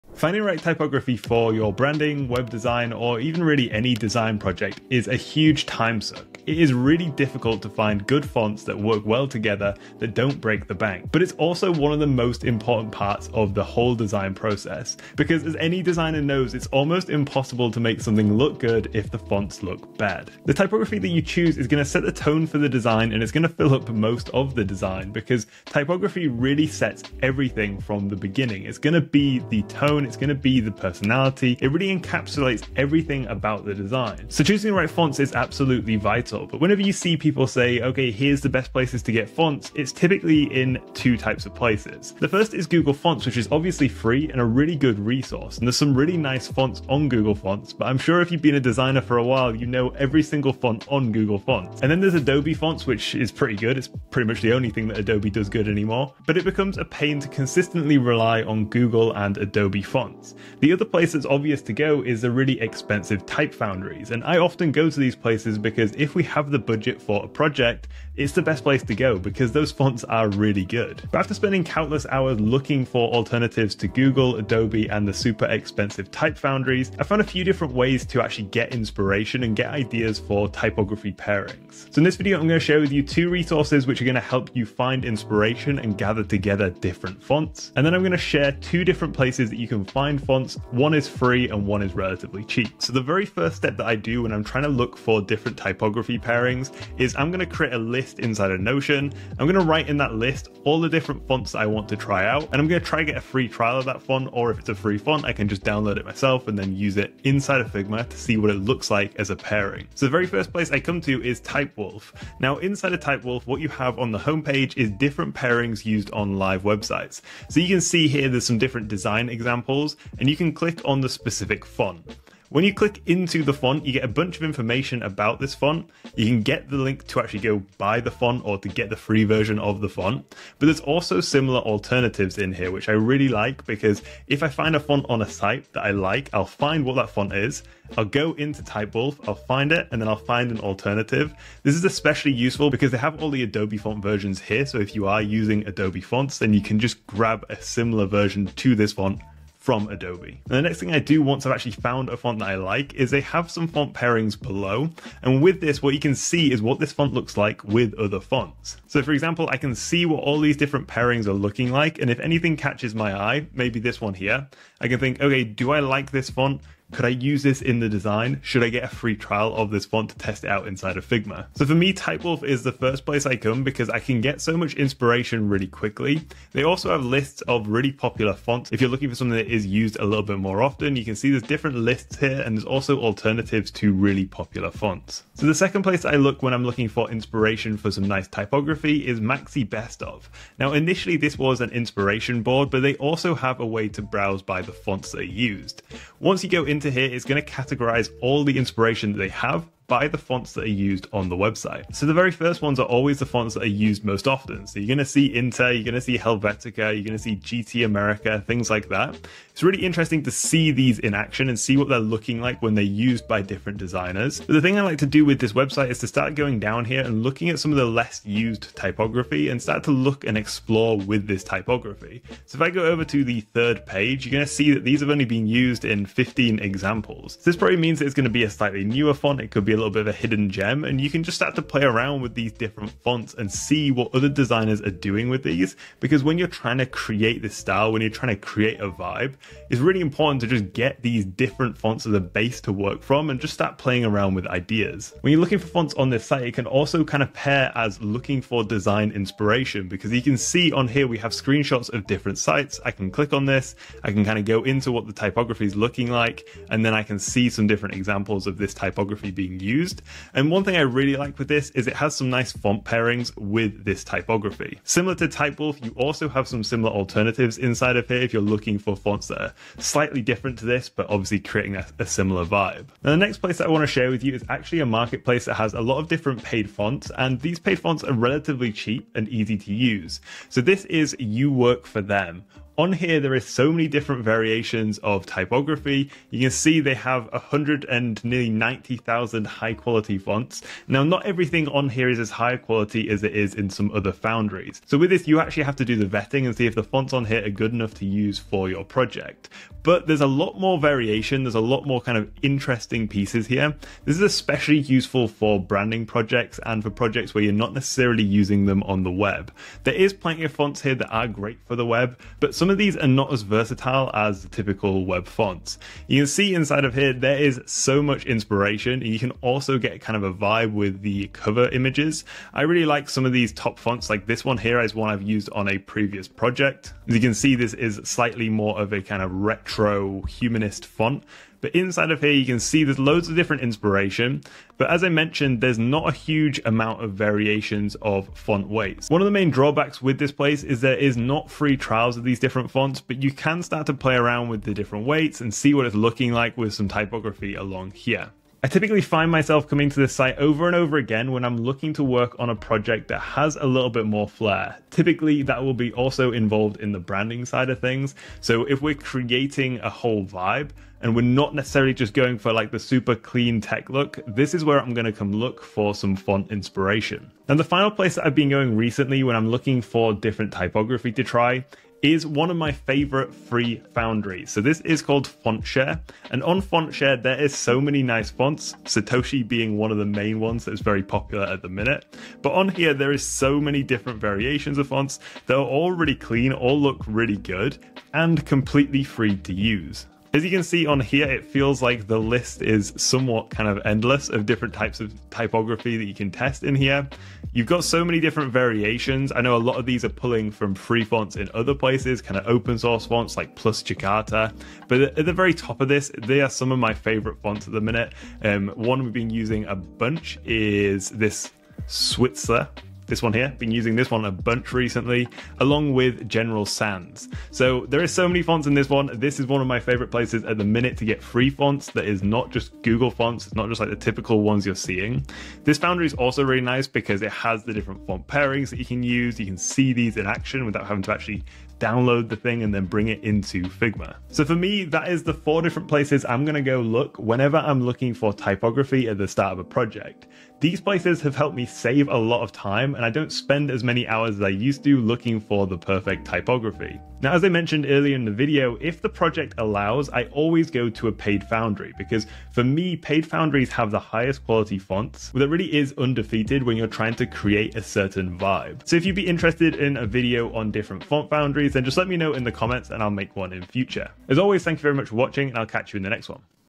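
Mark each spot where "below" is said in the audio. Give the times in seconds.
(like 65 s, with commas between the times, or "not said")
154 s.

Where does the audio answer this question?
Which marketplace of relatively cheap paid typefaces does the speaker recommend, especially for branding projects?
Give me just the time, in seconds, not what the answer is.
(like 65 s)
281 s.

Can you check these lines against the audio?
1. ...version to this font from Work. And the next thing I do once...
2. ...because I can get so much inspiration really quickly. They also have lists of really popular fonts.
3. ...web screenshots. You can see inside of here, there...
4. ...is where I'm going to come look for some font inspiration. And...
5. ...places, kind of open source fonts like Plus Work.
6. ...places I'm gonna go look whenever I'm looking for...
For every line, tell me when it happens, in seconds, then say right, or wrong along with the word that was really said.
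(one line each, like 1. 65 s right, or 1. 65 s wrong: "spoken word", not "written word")
1. 148 s wrong: "Adobe", not "Work"
2. 173 s right
3. 315 s wrong: "fonts", not "screenshots"
4. 364 s right
5. 401 s wrong: "Jakarta", not "Work"
6. 435 s right.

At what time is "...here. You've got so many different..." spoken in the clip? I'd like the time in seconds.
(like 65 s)
396 s.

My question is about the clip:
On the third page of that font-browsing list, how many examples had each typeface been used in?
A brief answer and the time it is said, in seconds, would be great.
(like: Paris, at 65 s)
15, at 226 s.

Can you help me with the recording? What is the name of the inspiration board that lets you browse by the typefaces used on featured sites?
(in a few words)
Maxi Best Of.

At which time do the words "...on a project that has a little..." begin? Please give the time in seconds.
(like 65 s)
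352 s.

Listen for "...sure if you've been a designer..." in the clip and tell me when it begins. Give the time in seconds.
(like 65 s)
47 s.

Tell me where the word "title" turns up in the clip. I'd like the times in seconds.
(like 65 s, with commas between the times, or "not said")
36 s.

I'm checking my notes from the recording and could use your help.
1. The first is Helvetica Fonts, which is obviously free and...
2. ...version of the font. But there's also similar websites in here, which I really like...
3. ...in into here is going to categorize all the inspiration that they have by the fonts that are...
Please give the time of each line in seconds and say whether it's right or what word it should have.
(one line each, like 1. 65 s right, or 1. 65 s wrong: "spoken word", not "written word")
1. 42 s wrong: "Google", not "Helvetica"
2. 129 s wrong: "alternatives", not "websites"
3. 196 s right.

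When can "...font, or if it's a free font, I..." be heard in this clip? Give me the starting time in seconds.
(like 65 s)
104 s.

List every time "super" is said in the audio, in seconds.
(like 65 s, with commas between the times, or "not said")
75 s, 362 s.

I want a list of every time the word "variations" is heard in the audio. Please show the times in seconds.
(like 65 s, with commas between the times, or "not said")
284 s, 300 s, 337 s, 384 s, 398 s.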